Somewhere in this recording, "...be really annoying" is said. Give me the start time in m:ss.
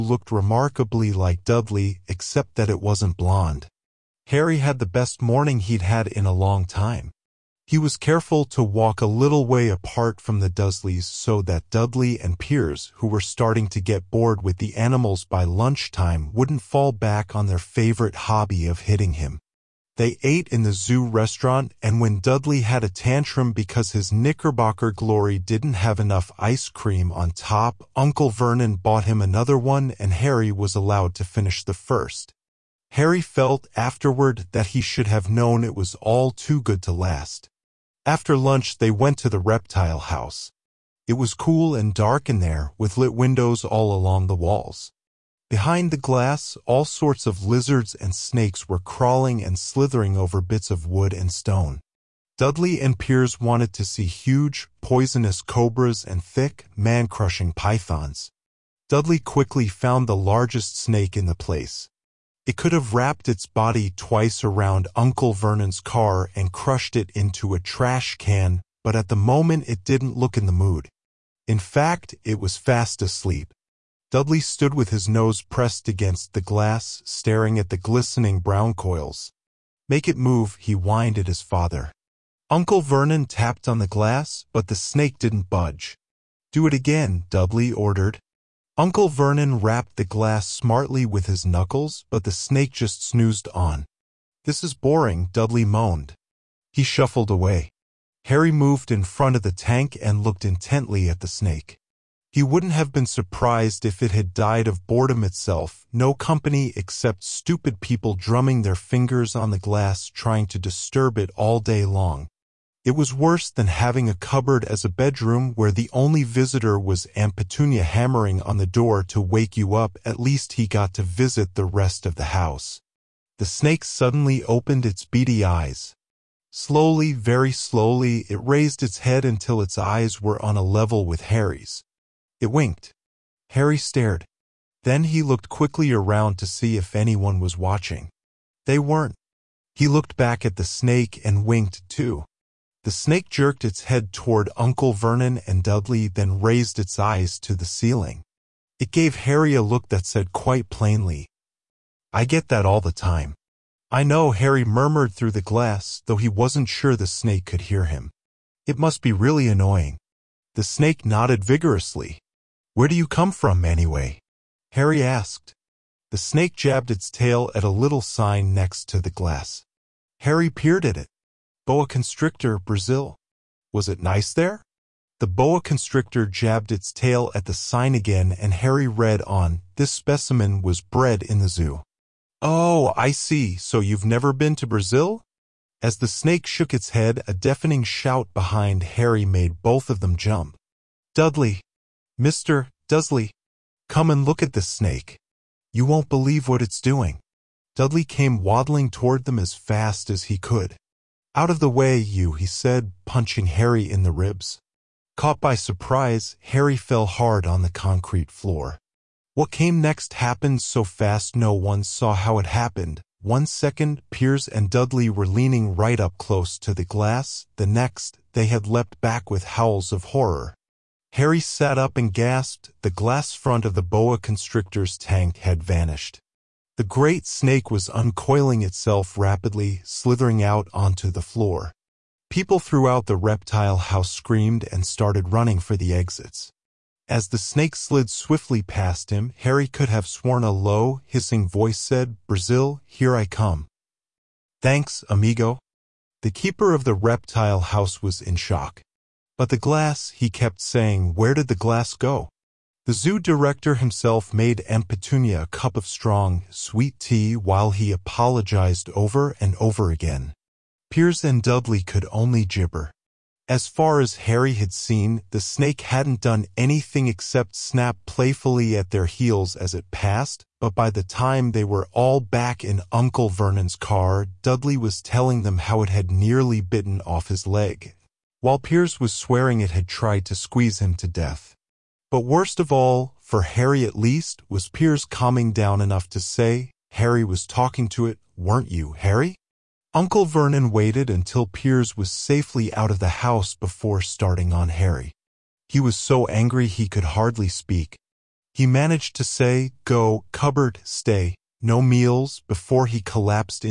2:39.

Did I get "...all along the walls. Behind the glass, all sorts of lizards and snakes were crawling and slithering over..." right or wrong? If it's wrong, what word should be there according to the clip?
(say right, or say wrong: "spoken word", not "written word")
right.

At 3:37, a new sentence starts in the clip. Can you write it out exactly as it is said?
The next, they had leapt back with howls of horror.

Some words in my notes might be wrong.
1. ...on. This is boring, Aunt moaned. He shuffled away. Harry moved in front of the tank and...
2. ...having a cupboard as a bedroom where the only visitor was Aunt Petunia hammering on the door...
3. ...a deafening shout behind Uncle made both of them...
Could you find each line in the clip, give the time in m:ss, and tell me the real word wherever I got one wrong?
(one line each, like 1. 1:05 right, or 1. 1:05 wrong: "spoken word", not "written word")
1. 1:33 wrong: "Dudley", not "Aunt"
2. 1:53 right
3. 3:07 wrong: "Harry", not "Uncle".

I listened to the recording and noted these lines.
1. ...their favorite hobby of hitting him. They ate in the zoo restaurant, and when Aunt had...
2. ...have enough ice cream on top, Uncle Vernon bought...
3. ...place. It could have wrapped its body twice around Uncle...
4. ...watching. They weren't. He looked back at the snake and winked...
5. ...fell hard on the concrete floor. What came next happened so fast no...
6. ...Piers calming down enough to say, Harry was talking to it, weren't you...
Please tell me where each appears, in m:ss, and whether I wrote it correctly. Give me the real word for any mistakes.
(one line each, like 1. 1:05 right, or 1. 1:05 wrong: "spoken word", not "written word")
1. 0:17 wrong: "Dudley", not "Aunt"
2. 0:25 right
3. 1:01 right
4. 2:17 right
5. 3:26 right
6. 4:44 right.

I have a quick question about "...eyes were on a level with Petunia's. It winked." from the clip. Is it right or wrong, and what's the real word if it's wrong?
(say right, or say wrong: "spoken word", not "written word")
wrong: "Harry", not "Petunia".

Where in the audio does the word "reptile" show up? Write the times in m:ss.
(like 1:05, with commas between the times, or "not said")
0:39, 3:53, 4:06.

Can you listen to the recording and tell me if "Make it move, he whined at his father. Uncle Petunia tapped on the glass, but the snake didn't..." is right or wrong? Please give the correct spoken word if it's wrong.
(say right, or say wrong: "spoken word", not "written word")
wrong: "Vernon", not "Petunia".